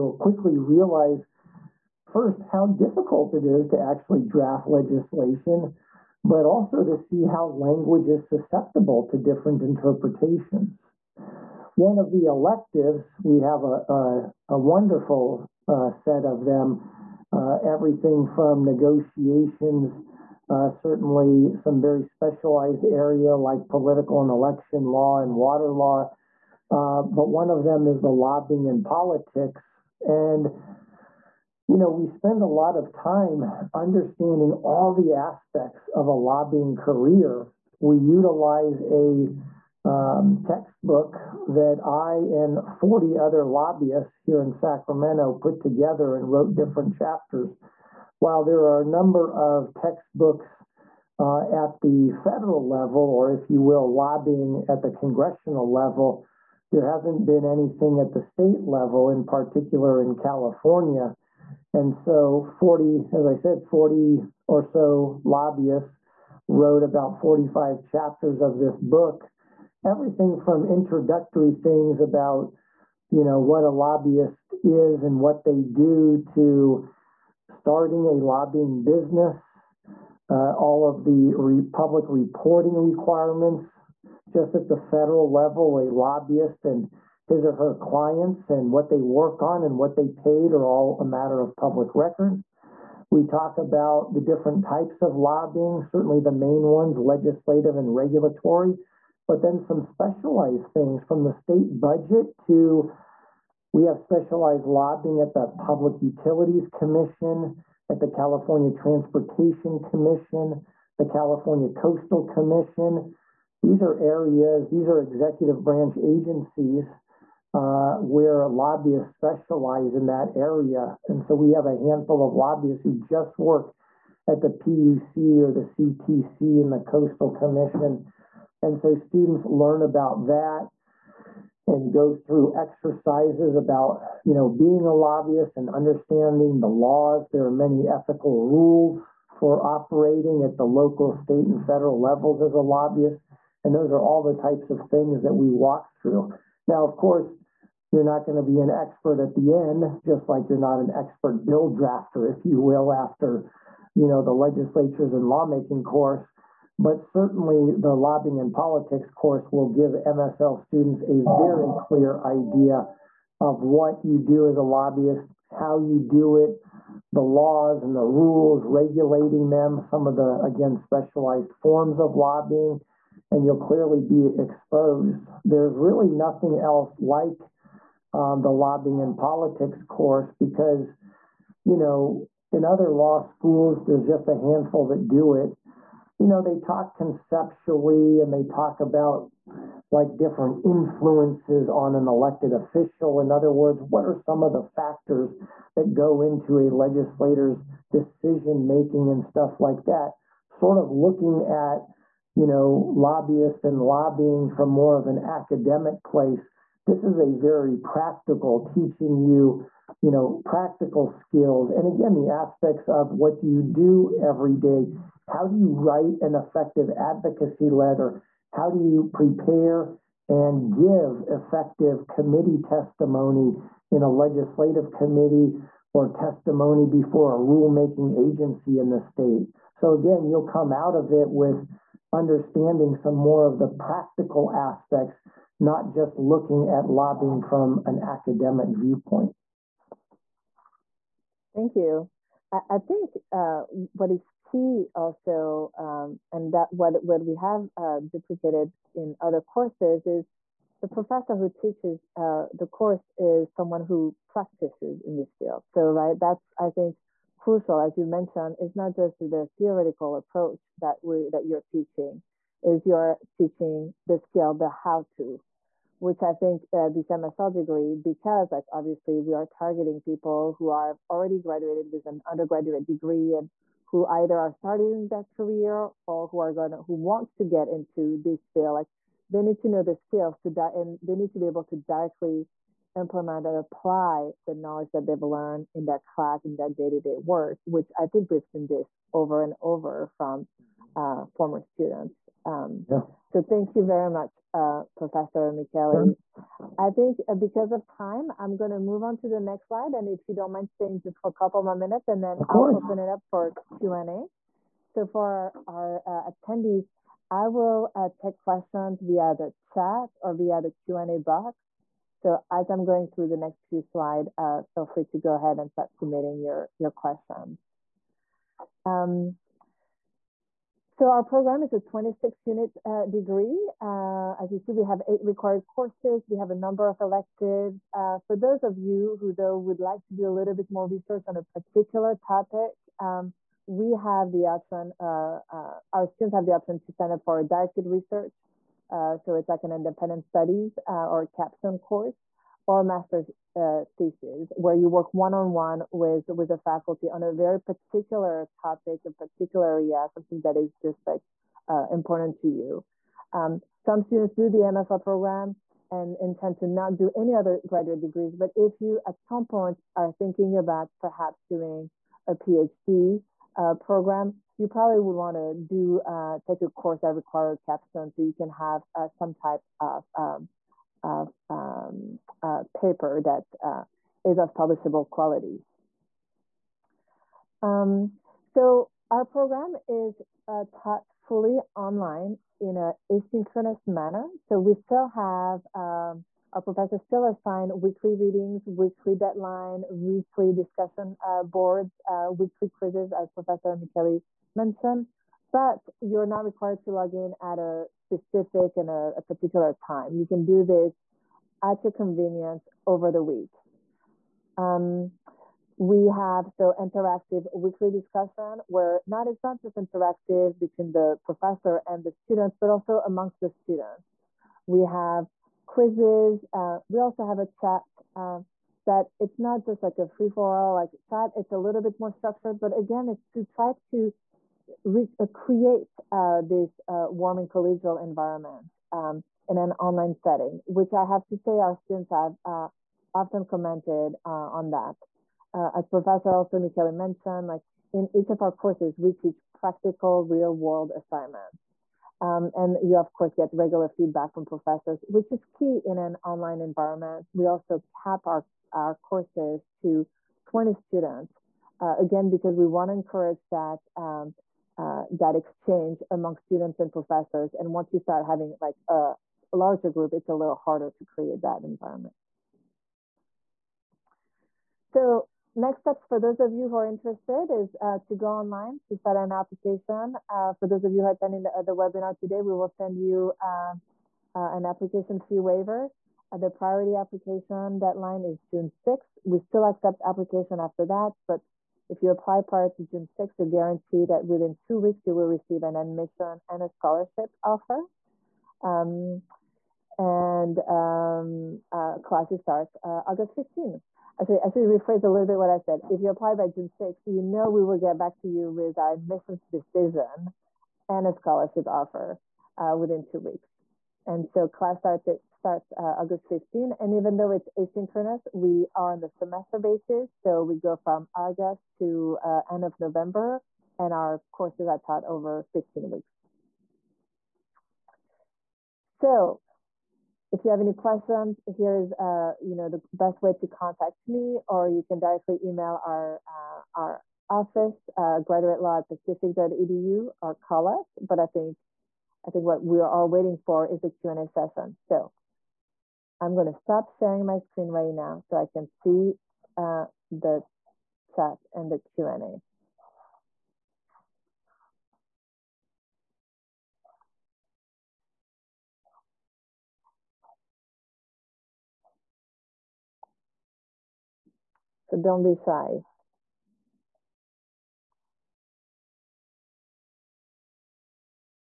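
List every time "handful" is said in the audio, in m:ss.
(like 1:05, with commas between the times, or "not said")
2:01, 3:04.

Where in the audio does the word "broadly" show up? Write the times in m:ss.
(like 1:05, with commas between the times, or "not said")
not said.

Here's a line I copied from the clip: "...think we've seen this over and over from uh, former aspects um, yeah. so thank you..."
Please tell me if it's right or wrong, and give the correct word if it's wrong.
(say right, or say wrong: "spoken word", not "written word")
wrong: "students", not "aspects".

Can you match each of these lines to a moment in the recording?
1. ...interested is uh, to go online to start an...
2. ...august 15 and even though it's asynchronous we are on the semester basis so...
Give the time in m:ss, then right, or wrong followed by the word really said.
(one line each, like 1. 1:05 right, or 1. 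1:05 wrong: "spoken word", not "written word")
1. 7:46 right
2. 8:25 right.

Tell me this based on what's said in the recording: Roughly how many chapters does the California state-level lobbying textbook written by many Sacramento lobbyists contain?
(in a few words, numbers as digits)
45.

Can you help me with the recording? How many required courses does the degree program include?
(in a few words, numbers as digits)
8.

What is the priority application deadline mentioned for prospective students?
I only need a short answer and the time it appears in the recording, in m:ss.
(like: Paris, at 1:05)
June 6, at 7:58.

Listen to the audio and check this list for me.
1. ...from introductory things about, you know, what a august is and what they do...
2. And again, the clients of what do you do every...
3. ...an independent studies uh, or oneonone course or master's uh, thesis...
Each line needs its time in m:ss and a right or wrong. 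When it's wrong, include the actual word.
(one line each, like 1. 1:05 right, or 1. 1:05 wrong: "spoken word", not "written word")
1. 1:10 wrong: "lobbyist", not "august"
2. 3:31 wrong: "aspects", not "clients"
3. 5:39 wrong: "capstone", not "oneonone".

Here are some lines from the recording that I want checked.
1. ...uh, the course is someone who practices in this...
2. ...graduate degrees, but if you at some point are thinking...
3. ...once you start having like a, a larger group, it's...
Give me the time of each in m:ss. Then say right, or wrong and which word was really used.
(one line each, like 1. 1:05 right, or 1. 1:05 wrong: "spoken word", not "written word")
1. 4:12 right
2. 5:57 right
3. 7:37 right.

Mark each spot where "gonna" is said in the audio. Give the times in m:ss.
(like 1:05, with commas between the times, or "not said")
4:36, 8:56.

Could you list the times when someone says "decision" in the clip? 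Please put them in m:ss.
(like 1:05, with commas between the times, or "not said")
3:17, 8:19.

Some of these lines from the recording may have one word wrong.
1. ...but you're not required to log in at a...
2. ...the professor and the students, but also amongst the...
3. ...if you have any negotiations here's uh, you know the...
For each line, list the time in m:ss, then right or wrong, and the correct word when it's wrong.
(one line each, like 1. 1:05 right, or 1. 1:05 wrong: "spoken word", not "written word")
1. 6:35 right
2. 6:50 right
3. 8:40 wrong: "questions", not "negotiations".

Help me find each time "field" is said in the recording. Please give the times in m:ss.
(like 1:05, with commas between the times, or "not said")
4:15, 4:38.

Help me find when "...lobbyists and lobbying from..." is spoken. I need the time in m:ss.
3:22.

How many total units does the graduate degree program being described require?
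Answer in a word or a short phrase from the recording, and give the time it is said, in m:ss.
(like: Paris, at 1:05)
26, at 5:21.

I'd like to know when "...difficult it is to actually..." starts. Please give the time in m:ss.
0:02.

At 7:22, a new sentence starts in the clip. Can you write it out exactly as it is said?
Um, and you of course get regular feedback from professors, which is key in an online environment.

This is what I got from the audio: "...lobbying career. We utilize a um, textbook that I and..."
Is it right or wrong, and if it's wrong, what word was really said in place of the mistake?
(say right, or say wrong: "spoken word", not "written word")
right.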